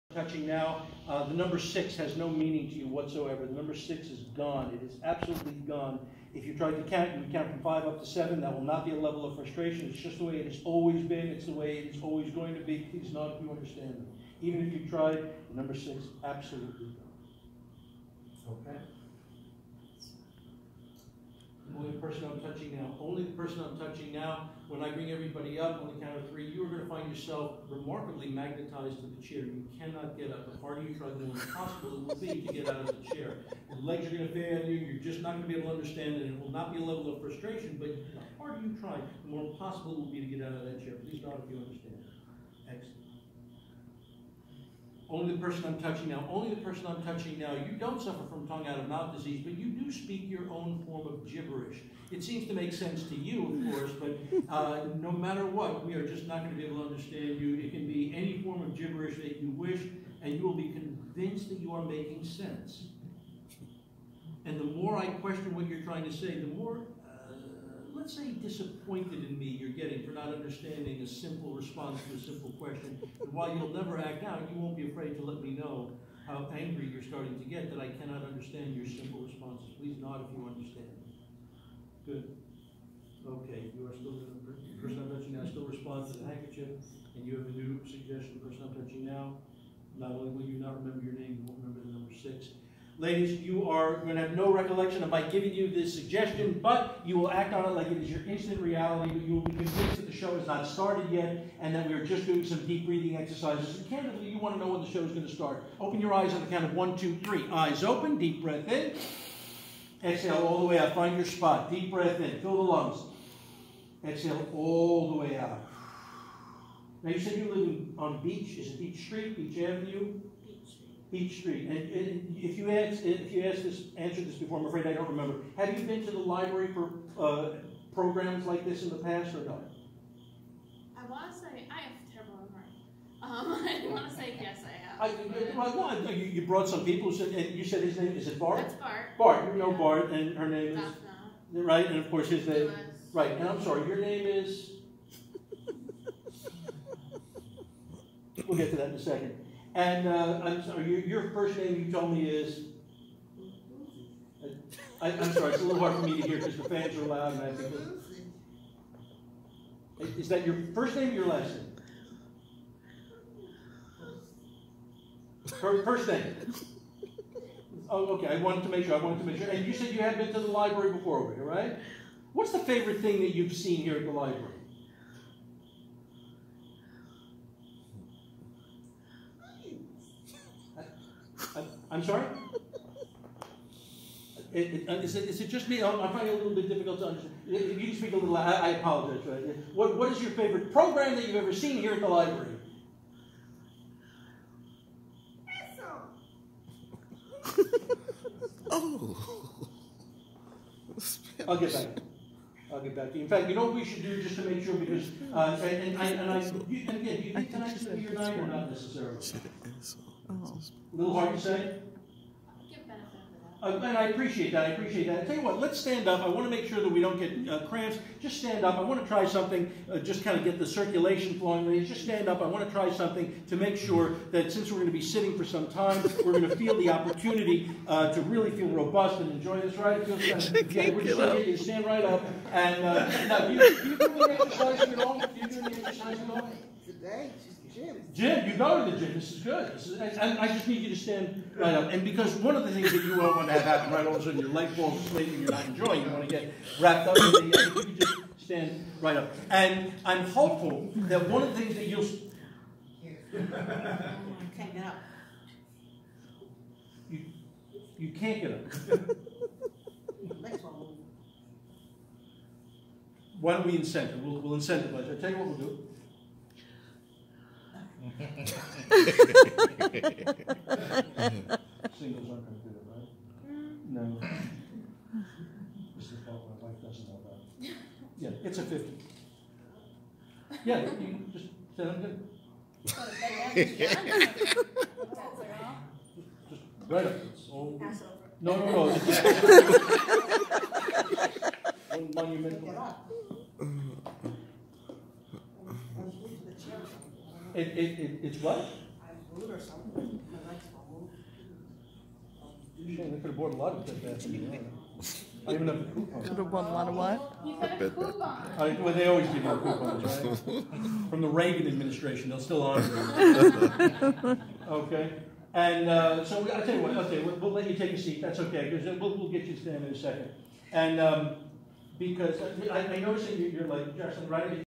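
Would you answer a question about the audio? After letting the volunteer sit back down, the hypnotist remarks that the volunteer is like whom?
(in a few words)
Jackson.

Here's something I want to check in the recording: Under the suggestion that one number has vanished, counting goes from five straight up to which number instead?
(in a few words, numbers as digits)
7.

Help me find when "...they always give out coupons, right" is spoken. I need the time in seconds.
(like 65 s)
308 s.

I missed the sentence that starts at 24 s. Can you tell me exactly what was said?
When I bring everybody up on the count of three, you are going to find yourself remarkably magnetized to the chair.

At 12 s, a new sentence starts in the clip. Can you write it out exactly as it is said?
Please not if you understand Even if you tried, number six absolutely gone.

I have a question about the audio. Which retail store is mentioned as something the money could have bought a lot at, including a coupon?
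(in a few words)
Bed Bath.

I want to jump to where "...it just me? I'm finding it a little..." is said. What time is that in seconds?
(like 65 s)
185 s.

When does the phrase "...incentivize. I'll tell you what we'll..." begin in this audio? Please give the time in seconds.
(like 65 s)
264 s.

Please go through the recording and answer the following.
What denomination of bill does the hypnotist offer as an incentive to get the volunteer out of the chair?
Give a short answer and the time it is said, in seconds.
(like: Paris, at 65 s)
50, at 278 s.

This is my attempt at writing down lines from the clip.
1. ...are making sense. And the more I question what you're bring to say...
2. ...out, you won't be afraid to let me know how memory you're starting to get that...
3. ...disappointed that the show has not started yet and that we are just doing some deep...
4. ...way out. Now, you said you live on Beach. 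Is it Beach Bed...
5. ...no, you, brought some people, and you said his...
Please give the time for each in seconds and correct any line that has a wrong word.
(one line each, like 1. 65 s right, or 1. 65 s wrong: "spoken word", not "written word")
1. 61 s wrong: "trying", not "bring"
2. 74 s wrong: "angry", not "memory"
3. 99 s wrong: "convinced", not "disappointed"
4. 115 s wrong: "Street", not "Bed"
5. 136 s right.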